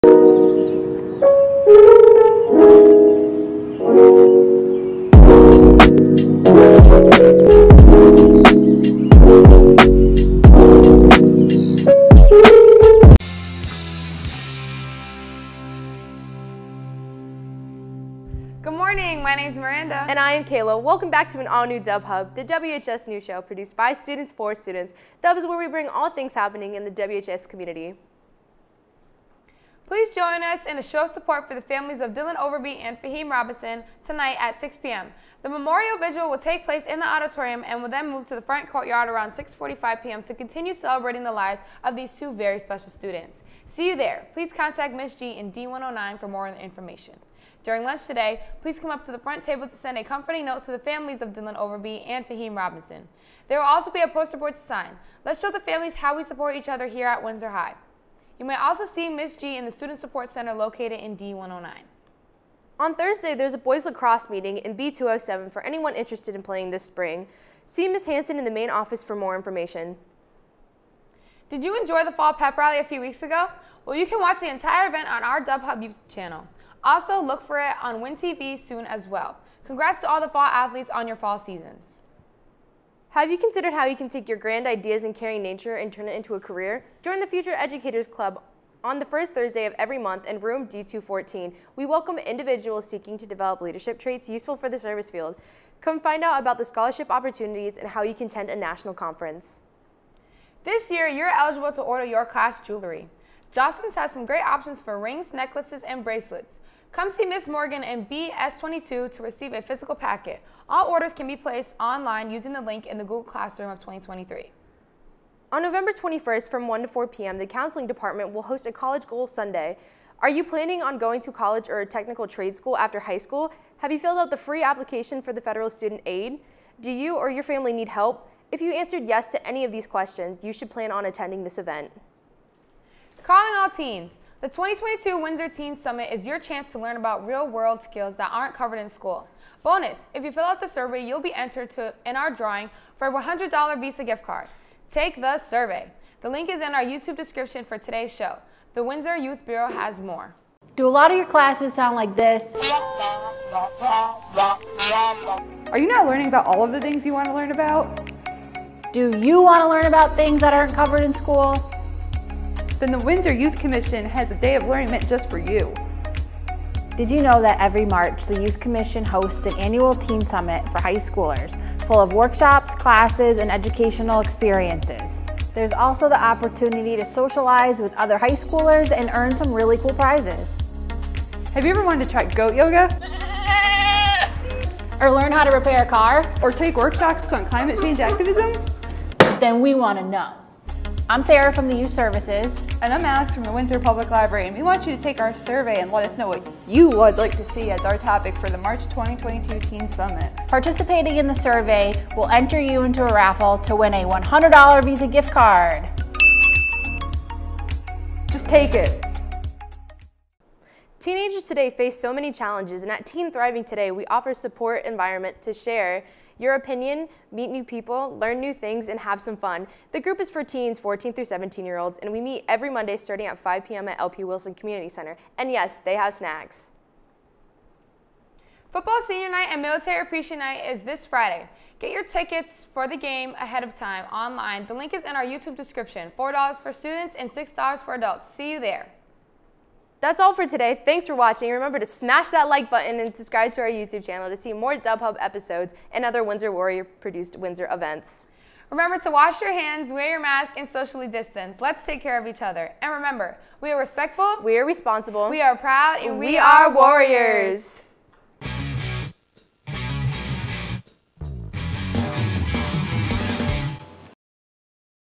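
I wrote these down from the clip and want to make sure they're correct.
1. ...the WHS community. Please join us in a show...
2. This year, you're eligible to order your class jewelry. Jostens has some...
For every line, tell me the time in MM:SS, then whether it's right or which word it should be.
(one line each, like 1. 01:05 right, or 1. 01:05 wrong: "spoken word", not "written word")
1. 00:26 right
2. 01:40 right.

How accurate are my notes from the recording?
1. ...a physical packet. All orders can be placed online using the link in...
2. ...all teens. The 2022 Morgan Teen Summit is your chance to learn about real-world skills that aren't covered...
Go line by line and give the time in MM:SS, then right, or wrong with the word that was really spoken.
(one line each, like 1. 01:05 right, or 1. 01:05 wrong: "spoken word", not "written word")
1. 01:49 right
2. 02:13 wrong: "Windsor", not "Morgan".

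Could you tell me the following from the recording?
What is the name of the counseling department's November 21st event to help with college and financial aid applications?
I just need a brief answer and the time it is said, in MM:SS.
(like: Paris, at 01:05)
College Goal Sunday, at 01:58.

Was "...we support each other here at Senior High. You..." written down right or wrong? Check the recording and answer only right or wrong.
wrong.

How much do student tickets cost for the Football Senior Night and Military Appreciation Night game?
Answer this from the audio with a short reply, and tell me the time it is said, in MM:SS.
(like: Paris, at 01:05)
$4, at 03:56.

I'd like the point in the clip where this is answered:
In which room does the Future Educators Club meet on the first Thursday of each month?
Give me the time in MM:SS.
01:30.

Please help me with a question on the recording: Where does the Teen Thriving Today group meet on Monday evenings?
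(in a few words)
LP Wilson Community Center.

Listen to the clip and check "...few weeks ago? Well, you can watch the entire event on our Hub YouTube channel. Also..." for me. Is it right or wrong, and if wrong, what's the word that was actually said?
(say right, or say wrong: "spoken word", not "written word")
right.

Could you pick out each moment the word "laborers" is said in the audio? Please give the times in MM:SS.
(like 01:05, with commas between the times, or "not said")
not said.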